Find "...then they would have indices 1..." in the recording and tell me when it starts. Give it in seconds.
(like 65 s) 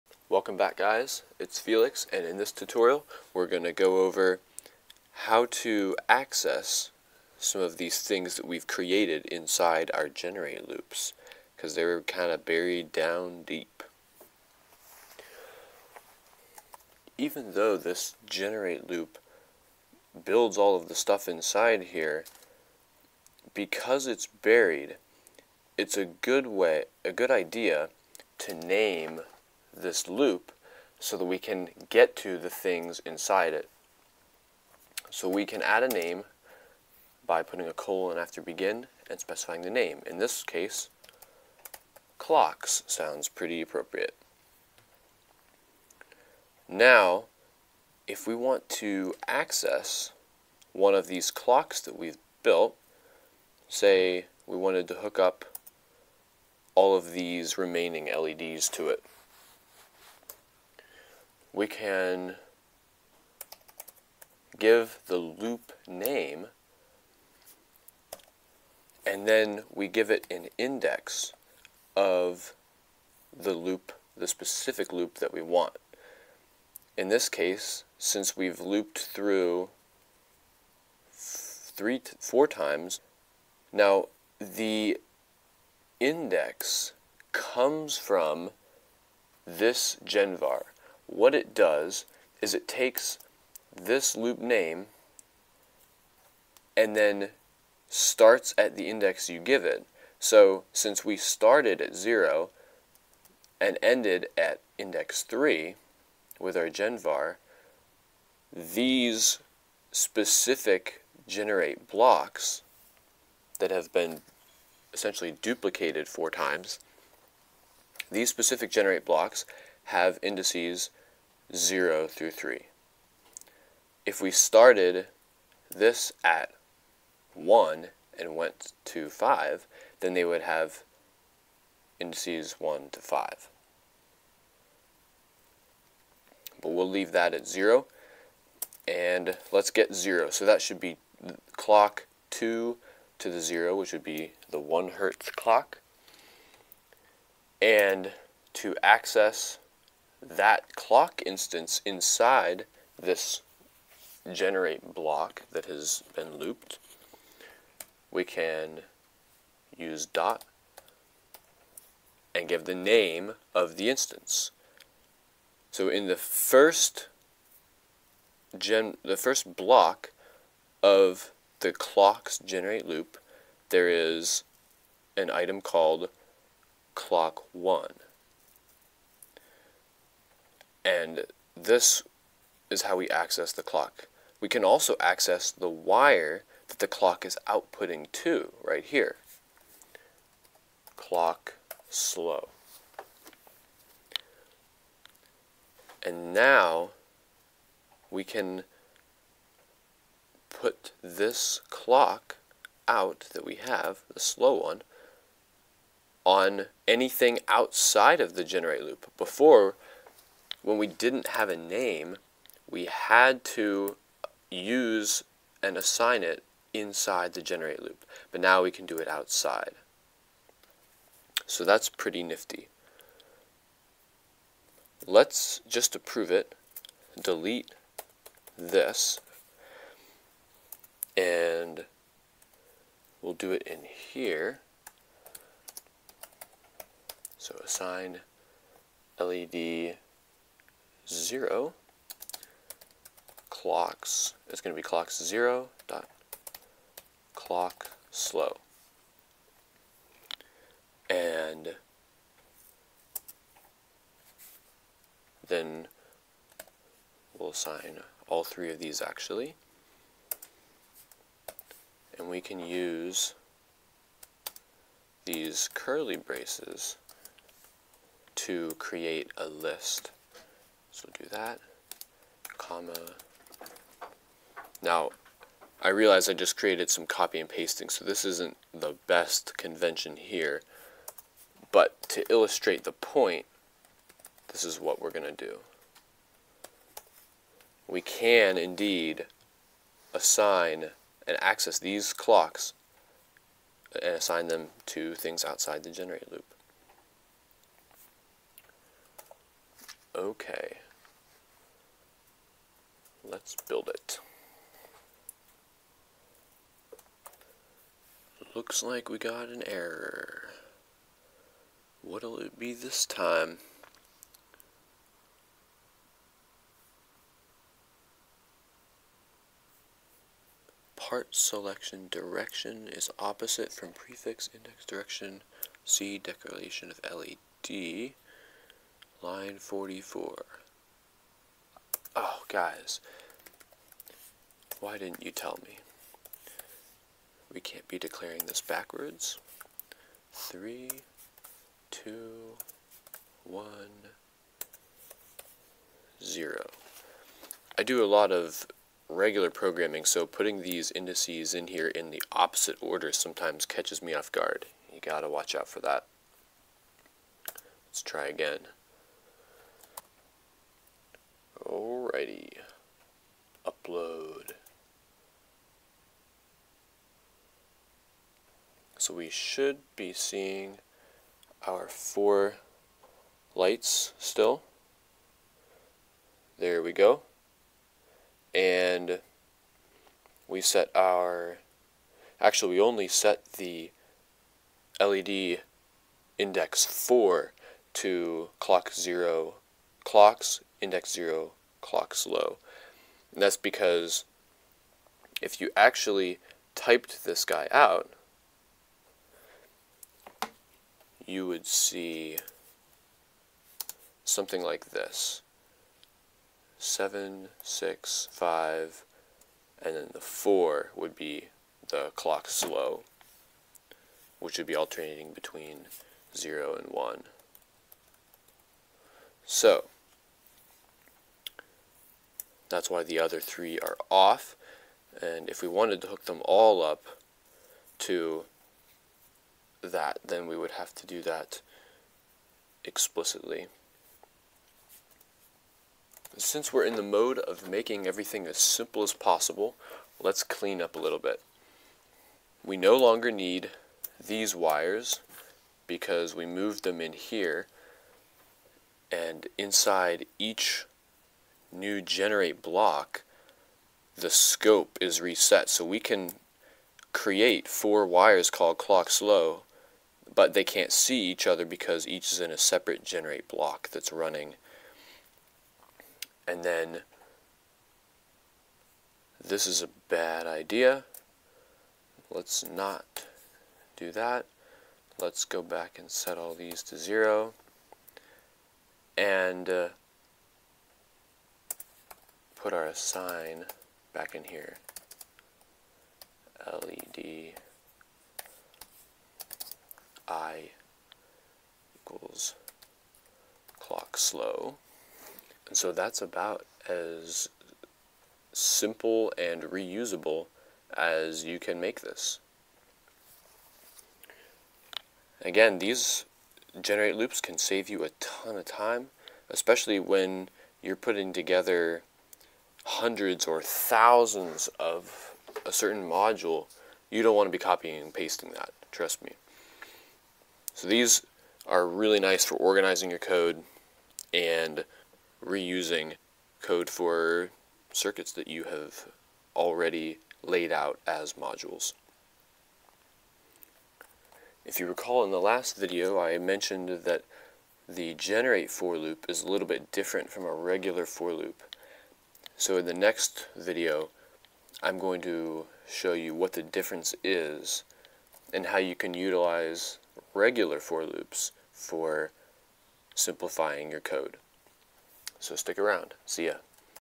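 129 s.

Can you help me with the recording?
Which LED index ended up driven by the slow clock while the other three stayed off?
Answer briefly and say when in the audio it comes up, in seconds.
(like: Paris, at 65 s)
4, at 384 s.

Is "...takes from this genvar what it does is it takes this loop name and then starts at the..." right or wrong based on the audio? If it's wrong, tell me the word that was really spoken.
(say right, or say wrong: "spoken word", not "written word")
wrong: "comes", not "takes".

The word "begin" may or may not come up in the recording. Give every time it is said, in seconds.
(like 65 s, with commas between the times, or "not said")
38 s.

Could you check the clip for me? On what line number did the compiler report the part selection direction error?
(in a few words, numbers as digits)
44.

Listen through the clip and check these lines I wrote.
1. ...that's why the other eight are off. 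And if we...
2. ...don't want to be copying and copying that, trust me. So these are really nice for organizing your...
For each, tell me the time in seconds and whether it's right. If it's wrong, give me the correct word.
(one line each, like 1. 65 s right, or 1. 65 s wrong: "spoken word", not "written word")
1. 422 s wrong: "three", not "eight"
2. 517 s wrong: "pasting", not "copying".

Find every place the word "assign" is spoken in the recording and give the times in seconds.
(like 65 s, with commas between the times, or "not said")
215 s, 237 s, 257 s, 290 s, 294 s, 482 s.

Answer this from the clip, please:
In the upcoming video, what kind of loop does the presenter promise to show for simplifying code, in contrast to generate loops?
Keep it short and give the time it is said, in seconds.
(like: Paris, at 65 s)
regular for loops, at 550 s.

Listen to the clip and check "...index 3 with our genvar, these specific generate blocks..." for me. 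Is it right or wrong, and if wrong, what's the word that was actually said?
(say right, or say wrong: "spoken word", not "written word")
right.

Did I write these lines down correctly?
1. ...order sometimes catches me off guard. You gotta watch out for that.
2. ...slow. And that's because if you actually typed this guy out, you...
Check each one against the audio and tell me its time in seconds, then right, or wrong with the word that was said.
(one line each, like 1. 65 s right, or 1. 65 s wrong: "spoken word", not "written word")
1. 352 s right
2. 392 s right.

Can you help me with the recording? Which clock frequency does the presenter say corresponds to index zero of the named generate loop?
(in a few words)
1 hertz.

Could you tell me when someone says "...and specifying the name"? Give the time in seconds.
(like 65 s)
39 s.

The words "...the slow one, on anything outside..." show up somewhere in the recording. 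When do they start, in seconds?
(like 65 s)
204 s.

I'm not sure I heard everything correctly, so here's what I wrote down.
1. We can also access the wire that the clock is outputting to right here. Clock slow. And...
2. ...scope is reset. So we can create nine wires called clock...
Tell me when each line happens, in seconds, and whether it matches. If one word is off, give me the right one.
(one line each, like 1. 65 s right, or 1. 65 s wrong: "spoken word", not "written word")
1. 184 s right
2. 454 s wrong: "four", not "nine".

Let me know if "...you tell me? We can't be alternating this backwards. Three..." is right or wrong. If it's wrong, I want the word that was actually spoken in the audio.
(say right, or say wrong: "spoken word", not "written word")
wrong: "declaring", not "alternating".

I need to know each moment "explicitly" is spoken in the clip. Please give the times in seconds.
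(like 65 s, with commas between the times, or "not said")
432 s.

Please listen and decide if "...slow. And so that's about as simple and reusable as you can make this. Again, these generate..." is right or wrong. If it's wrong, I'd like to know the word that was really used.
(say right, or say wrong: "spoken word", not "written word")
right.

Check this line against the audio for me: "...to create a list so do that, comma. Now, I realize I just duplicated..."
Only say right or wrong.
wrong.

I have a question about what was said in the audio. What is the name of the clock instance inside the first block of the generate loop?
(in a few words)
clock 1.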